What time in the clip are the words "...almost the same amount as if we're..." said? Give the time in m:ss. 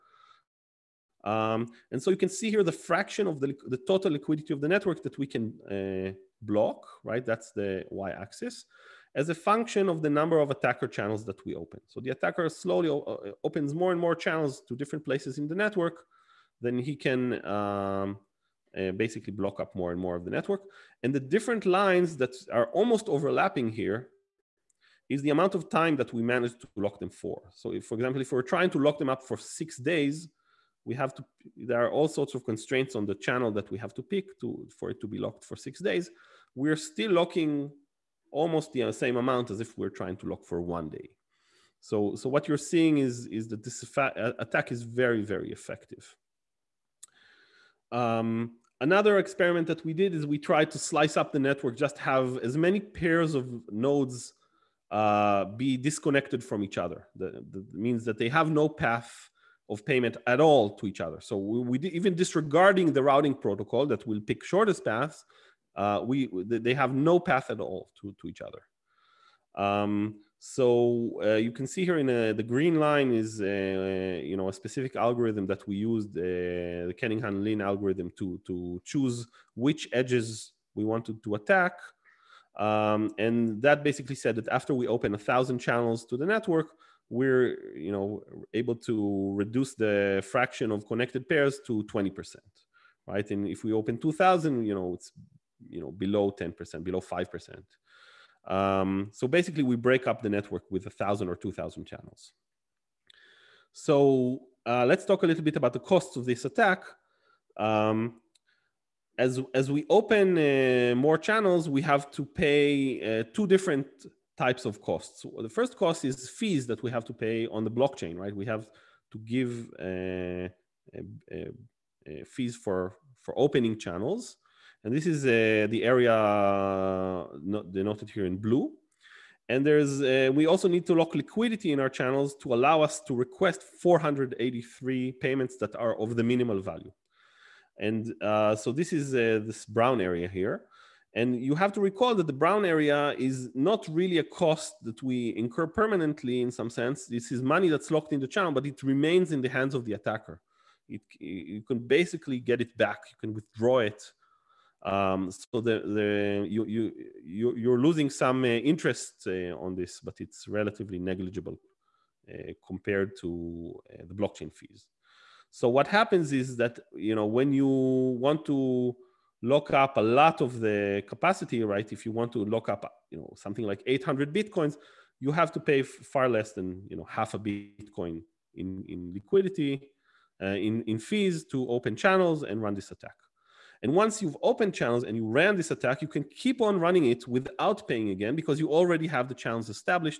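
0:38.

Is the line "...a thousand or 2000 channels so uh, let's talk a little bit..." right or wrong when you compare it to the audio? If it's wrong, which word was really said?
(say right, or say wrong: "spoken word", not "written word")
right.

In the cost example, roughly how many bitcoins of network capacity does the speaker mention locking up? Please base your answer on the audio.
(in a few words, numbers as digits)
800.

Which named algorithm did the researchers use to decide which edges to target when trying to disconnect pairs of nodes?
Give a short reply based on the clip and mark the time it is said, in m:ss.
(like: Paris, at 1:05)
Kernighan-Lin, at 1:17.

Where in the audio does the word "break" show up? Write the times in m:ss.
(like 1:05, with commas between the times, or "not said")
1:39.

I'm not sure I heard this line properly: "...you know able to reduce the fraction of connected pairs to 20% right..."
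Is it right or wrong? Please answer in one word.
right.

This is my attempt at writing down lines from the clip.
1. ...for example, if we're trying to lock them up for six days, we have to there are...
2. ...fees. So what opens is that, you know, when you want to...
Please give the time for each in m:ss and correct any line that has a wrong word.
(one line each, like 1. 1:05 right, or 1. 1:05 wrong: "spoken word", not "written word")
1. 0:27 right
2. 2:44 wrong: "happens", not "opens".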